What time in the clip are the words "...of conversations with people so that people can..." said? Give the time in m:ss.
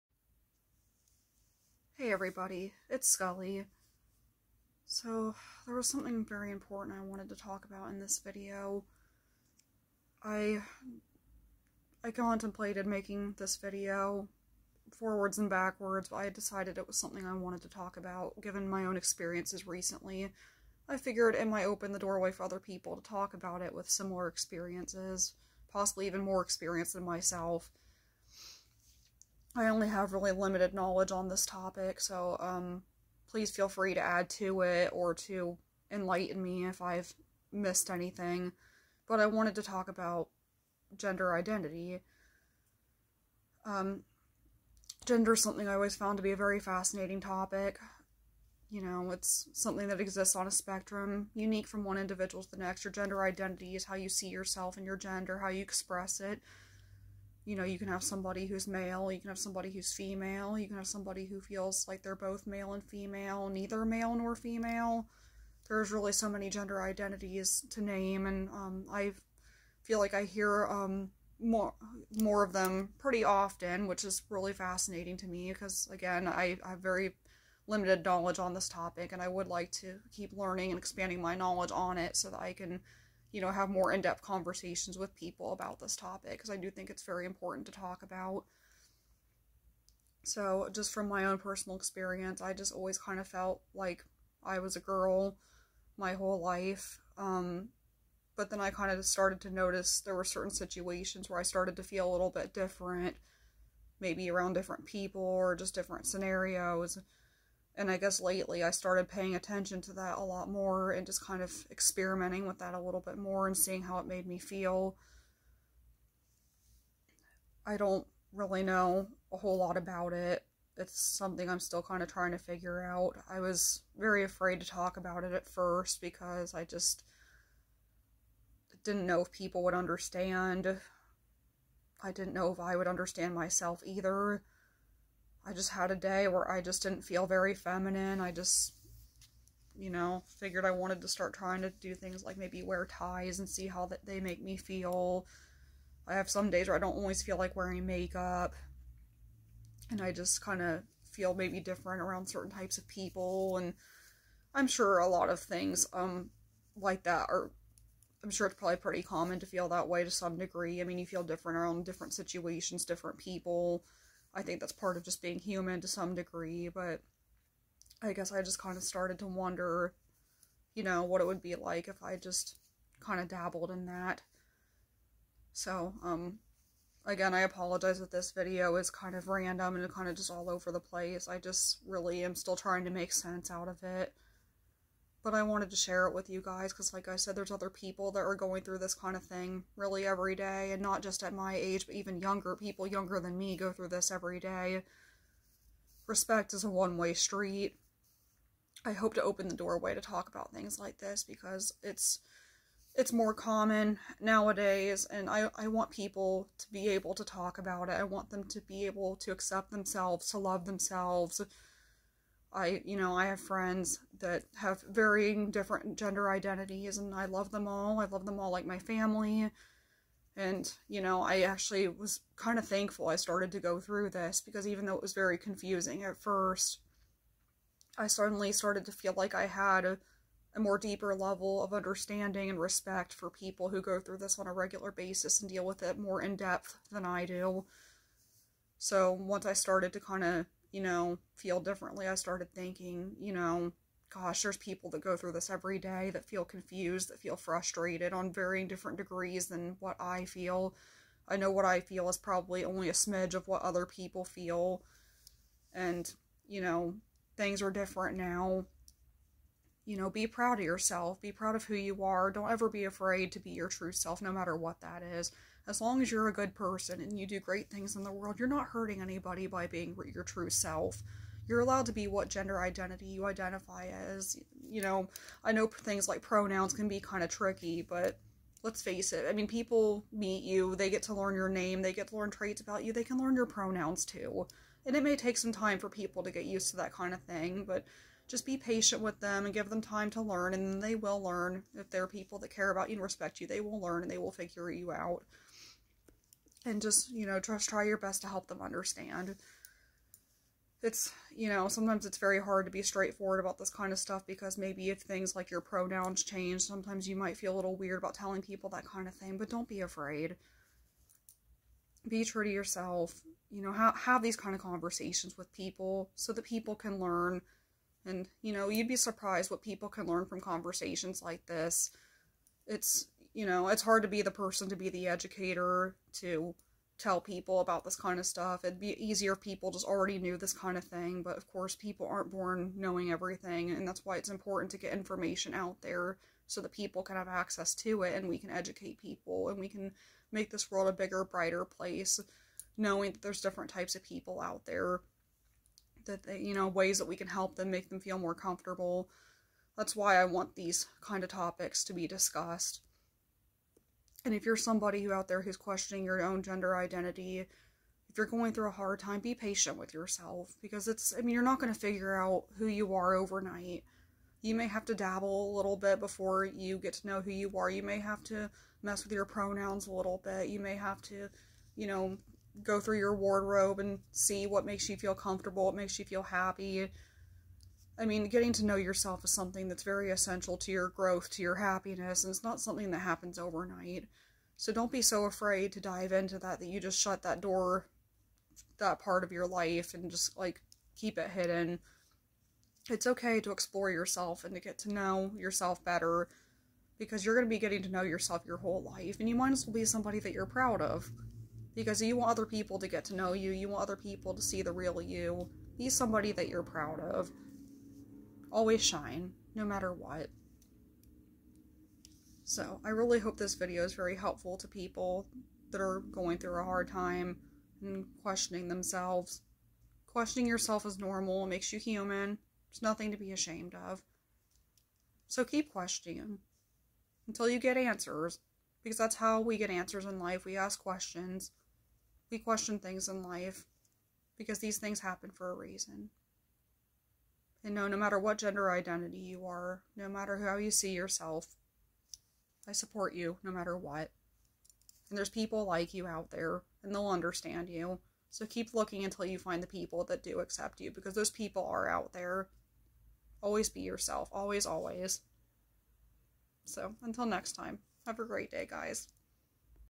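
5:14.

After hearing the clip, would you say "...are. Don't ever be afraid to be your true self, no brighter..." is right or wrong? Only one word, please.
wrong.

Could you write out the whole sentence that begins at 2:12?
I didn't know if I would understand myself either.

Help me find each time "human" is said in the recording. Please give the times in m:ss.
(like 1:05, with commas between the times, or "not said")
2:45, 7:01.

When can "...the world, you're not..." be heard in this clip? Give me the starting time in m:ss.
4:28.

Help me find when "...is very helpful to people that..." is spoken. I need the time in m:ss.
6:53.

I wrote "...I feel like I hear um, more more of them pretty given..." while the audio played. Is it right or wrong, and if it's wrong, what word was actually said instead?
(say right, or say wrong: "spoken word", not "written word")
wrong: "often", not "given".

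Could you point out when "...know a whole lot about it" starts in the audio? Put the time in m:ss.
1:58.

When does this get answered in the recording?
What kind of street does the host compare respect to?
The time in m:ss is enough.
3:16.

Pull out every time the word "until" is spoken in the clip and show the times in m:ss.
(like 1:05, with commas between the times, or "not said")
7:07, 7:29, 7:37.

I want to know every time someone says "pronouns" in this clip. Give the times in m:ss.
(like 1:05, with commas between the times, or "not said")
4:36, 4:43, 5:05, 6:09.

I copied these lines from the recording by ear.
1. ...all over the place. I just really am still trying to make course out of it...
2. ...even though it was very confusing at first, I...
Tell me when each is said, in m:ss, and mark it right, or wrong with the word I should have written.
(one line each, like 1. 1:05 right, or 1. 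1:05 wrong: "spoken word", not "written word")
1. 3:00 wrong: "sense", not "course"
2. 3:44 right.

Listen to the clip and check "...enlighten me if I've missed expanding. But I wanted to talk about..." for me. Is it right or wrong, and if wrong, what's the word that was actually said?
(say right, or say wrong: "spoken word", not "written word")
wrong: "anything", not "expanding".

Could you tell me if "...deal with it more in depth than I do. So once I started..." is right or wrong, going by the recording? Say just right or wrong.
right.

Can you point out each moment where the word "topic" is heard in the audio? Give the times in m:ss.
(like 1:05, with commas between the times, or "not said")
0:31, 0:47, 1:18, 1:25, 5:51.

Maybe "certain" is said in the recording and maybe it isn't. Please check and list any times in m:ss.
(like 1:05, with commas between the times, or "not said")
1:40, 2:32.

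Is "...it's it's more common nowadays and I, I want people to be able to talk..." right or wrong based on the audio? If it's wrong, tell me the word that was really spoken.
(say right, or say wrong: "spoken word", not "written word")
right.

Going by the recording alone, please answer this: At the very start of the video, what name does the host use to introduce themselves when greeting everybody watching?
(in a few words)
Skully.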